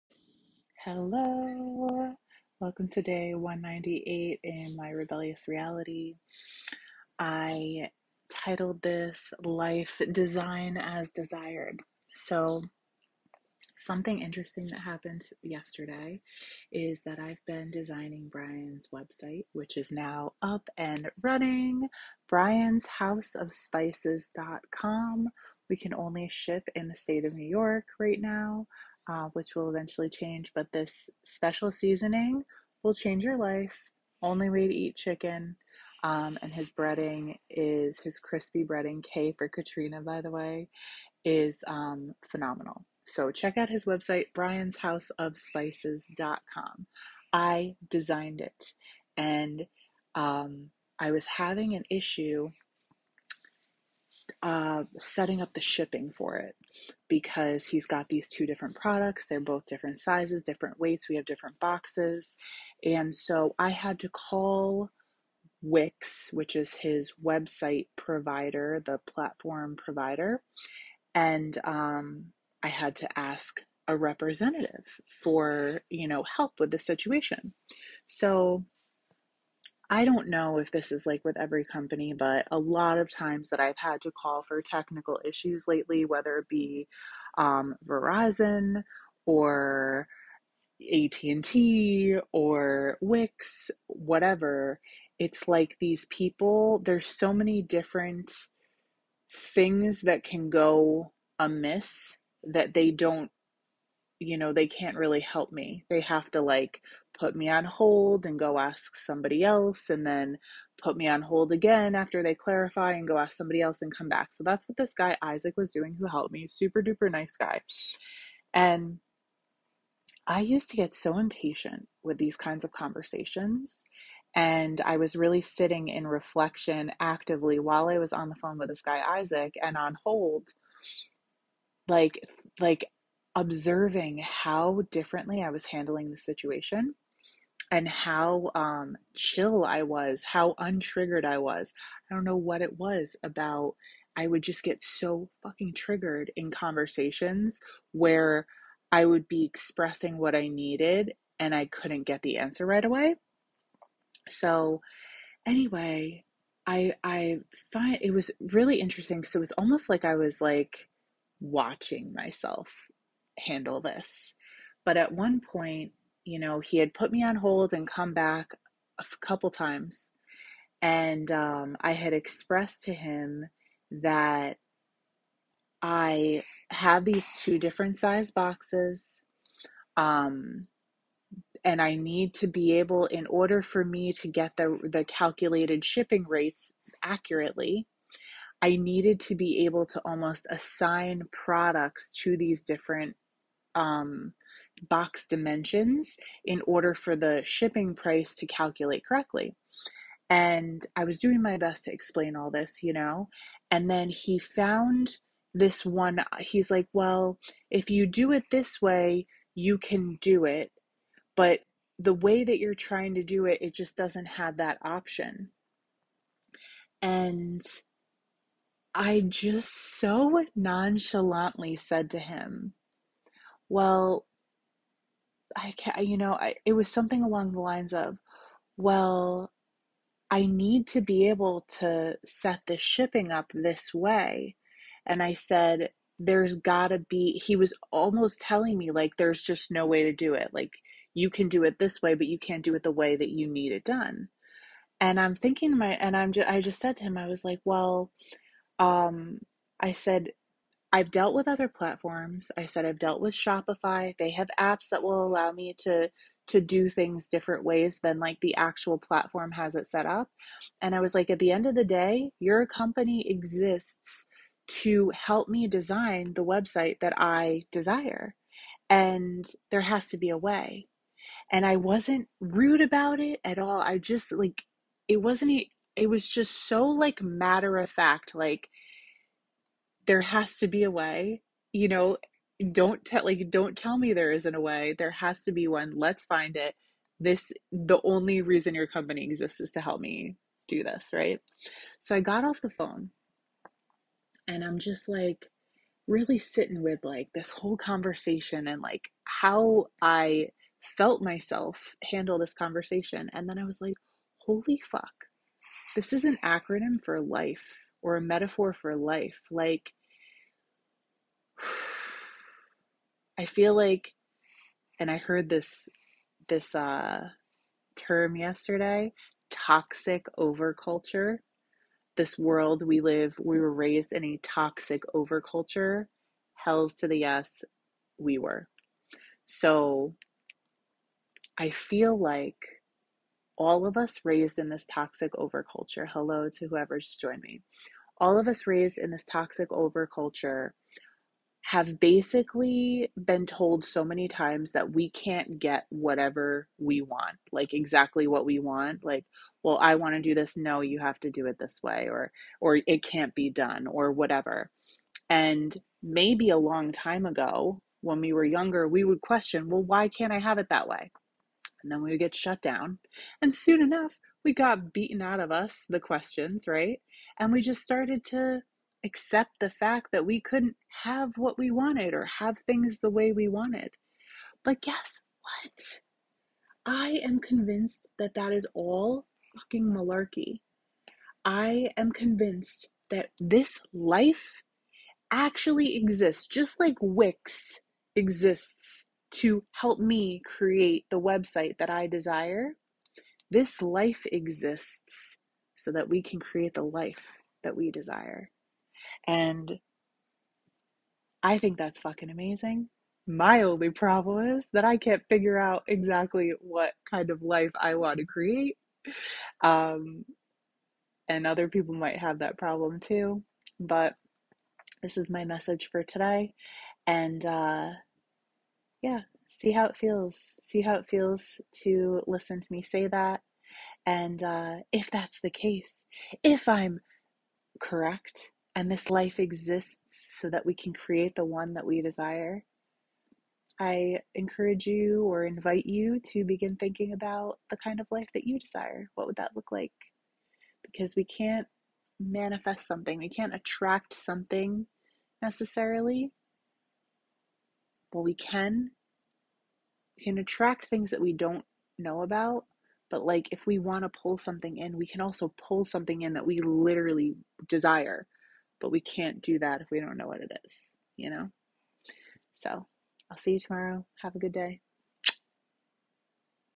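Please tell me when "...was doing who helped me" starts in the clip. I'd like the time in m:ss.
1:55.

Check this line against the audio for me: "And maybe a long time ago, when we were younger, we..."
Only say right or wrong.
right.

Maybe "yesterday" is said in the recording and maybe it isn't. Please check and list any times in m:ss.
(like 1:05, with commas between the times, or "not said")
0:15, 5:18.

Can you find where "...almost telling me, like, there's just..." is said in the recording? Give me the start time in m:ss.
3:57.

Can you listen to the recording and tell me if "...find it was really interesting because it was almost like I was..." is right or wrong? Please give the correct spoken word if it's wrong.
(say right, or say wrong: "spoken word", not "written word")
right.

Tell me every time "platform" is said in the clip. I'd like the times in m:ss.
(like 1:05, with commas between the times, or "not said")
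1:09, 4:11, 4:18.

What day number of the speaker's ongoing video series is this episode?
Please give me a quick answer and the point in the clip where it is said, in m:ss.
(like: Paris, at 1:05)
198, at 0:03.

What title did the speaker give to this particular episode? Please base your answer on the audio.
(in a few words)
Life Design as Desired.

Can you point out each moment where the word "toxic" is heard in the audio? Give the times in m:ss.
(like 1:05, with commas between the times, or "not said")
5:19, 5:24, 5:34, 5:39.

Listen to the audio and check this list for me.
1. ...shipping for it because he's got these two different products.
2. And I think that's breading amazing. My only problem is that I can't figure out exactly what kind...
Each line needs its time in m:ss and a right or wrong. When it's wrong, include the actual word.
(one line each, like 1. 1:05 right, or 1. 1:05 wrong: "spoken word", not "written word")
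1. 0:55 right
2. 6:39 wrong: "fucking", not "breading".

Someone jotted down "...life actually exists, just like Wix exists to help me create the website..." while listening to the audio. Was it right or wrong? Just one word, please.
right.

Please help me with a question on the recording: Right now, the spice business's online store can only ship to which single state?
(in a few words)
New York.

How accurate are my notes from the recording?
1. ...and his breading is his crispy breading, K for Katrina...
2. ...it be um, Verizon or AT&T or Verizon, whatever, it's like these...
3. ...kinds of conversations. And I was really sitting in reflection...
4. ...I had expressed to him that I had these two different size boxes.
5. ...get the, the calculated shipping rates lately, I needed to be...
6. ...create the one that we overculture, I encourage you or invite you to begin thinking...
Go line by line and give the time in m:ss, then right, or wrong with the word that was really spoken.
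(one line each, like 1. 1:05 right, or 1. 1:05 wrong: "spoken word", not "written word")
1. 0:36 right
2. 1:26 wrong: "Wix", not "Verizon"
3. 2:02 right
4. 2:51 right
5. 3:04 wrong: "accurately", not "lately"
6. 7:10 wrong: "desire", not "overculture".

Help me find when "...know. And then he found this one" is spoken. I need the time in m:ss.
3:22.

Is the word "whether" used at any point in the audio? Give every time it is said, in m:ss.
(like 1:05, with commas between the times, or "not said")
1:26.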